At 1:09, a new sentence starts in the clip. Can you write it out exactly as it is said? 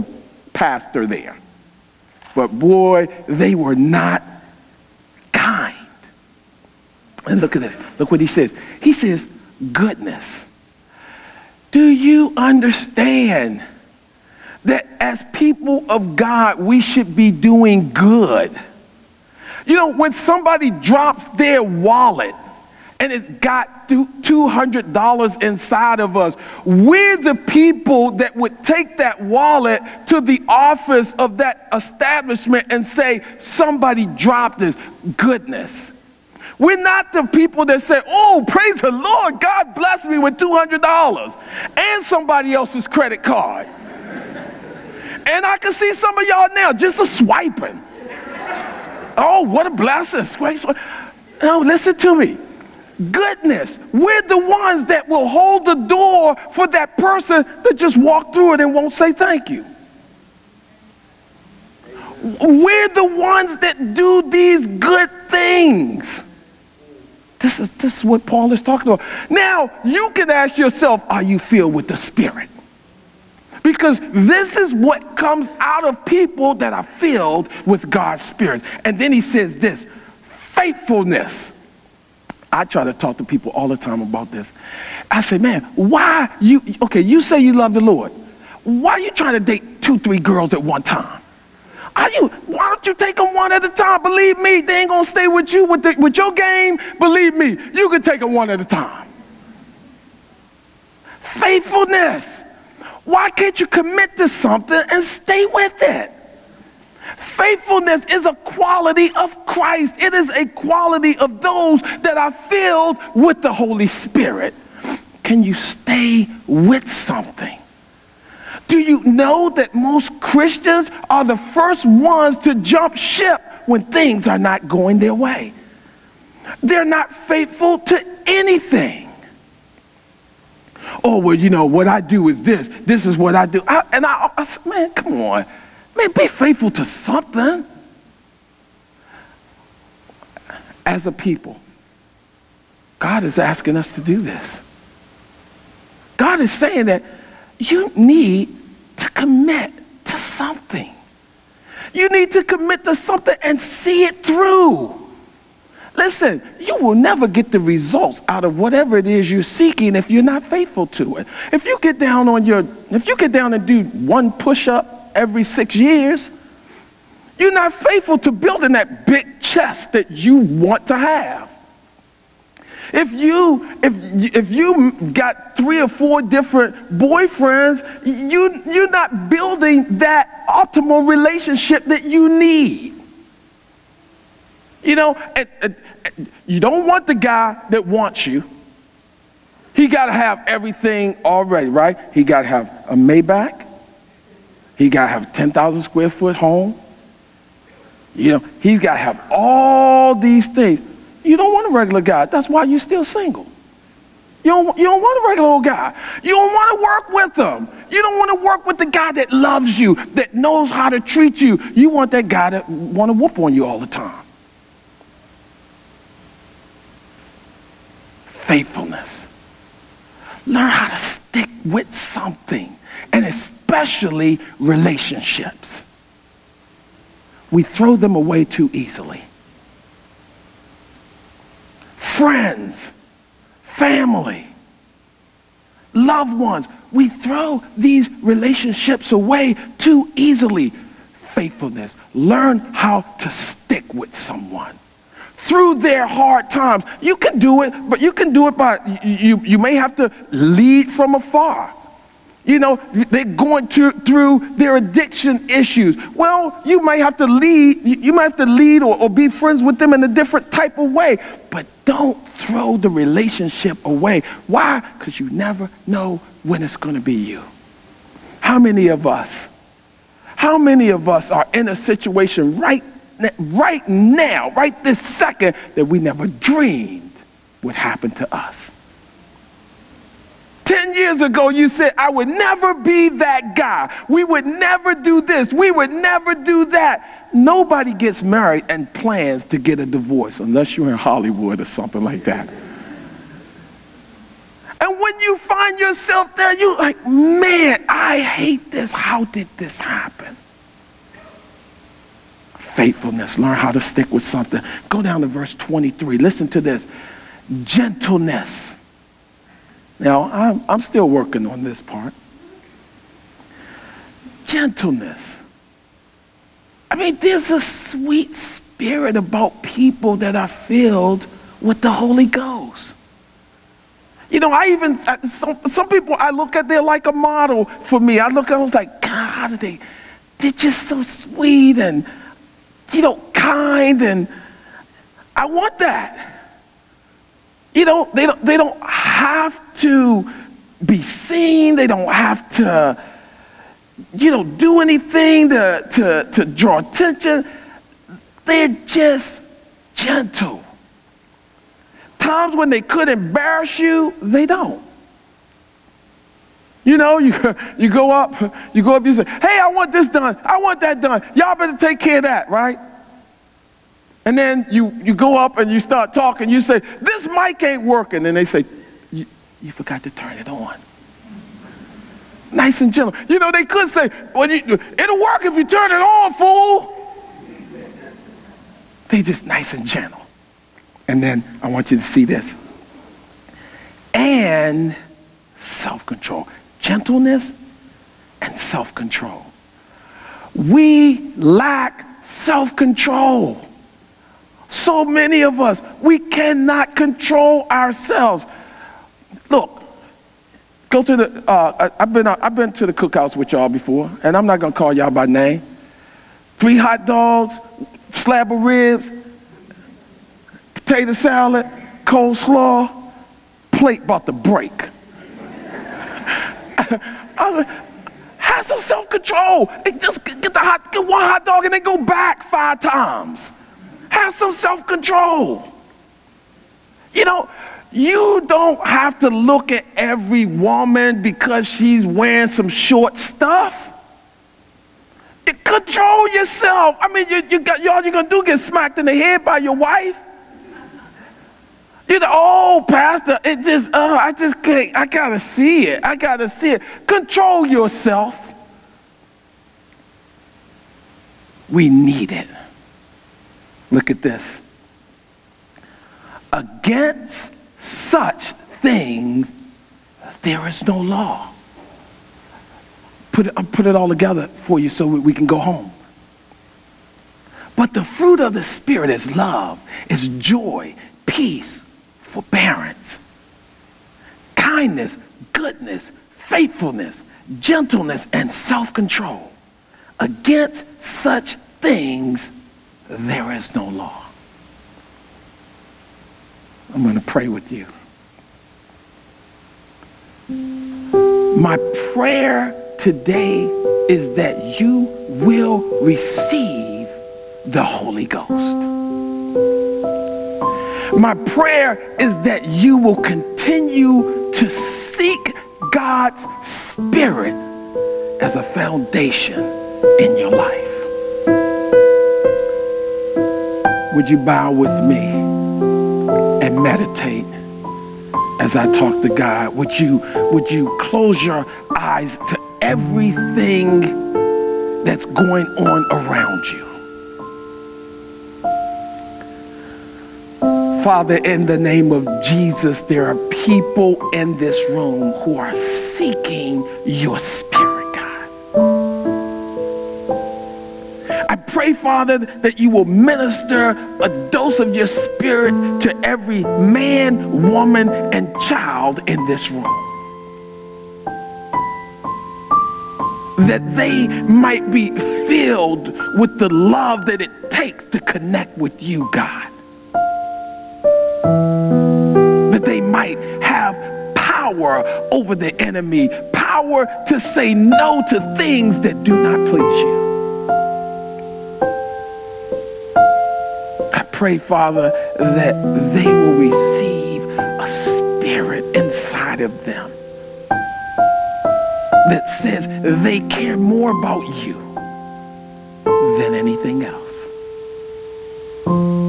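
Now, you can ask yourself, are you filled with the Spirit?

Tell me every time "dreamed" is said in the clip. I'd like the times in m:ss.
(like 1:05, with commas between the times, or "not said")
4:36.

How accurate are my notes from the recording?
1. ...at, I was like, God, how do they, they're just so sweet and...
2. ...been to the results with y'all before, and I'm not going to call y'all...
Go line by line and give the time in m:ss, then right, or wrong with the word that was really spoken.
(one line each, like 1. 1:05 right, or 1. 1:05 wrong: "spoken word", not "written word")
1. 5:28 right
2. 6:42 wrong: "cookouts", not "results".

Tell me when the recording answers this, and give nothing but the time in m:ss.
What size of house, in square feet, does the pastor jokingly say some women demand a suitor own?
3:15.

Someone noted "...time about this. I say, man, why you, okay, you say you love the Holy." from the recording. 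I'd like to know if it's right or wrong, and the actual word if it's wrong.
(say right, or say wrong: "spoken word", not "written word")
wrong: "Lord", not "Holy".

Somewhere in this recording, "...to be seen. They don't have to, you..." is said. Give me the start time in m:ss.
5:39.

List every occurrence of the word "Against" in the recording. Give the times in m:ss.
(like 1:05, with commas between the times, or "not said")
7:36, 8:00.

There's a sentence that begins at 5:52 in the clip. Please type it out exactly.
Times when they could embarrass you, they don't.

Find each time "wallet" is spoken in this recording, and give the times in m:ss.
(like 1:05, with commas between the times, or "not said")
0:21, 0:29.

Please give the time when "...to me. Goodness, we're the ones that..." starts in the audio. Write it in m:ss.
0:51.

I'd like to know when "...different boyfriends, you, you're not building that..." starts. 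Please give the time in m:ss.
2:56.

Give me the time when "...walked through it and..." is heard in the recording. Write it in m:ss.
0:57.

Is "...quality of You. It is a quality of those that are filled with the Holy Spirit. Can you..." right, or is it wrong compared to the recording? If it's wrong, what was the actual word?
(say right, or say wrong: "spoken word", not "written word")
wrong: "Christ", not "You".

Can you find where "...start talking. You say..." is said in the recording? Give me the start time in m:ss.
6:05.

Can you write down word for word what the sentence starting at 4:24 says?
Because you never know when it's going to be you.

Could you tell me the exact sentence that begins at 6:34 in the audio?
So many of us, we cannot control ourselves.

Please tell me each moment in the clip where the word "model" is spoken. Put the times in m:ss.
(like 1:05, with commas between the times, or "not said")
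5:27.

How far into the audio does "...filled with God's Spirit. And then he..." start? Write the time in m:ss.
1:16.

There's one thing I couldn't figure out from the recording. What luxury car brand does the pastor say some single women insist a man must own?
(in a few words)
Maybach.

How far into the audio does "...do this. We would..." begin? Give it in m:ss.
4:44.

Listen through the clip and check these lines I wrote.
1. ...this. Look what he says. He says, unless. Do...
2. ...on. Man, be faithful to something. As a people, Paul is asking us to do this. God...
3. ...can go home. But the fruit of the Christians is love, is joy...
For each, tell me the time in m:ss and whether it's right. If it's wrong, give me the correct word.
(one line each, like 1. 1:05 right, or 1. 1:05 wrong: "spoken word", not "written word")
1. 0:07 wrong: "goodness", not "unless"
2. 2:15 wrong: "God", not "Paul"
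3. 7:45 wrong: "Spirit", not "Christians".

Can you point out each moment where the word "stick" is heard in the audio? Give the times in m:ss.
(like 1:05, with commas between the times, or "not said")
3:40, 4:03, 5:03.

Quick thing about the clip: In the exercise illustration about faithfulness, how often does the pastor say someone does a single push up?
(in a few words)
every six years.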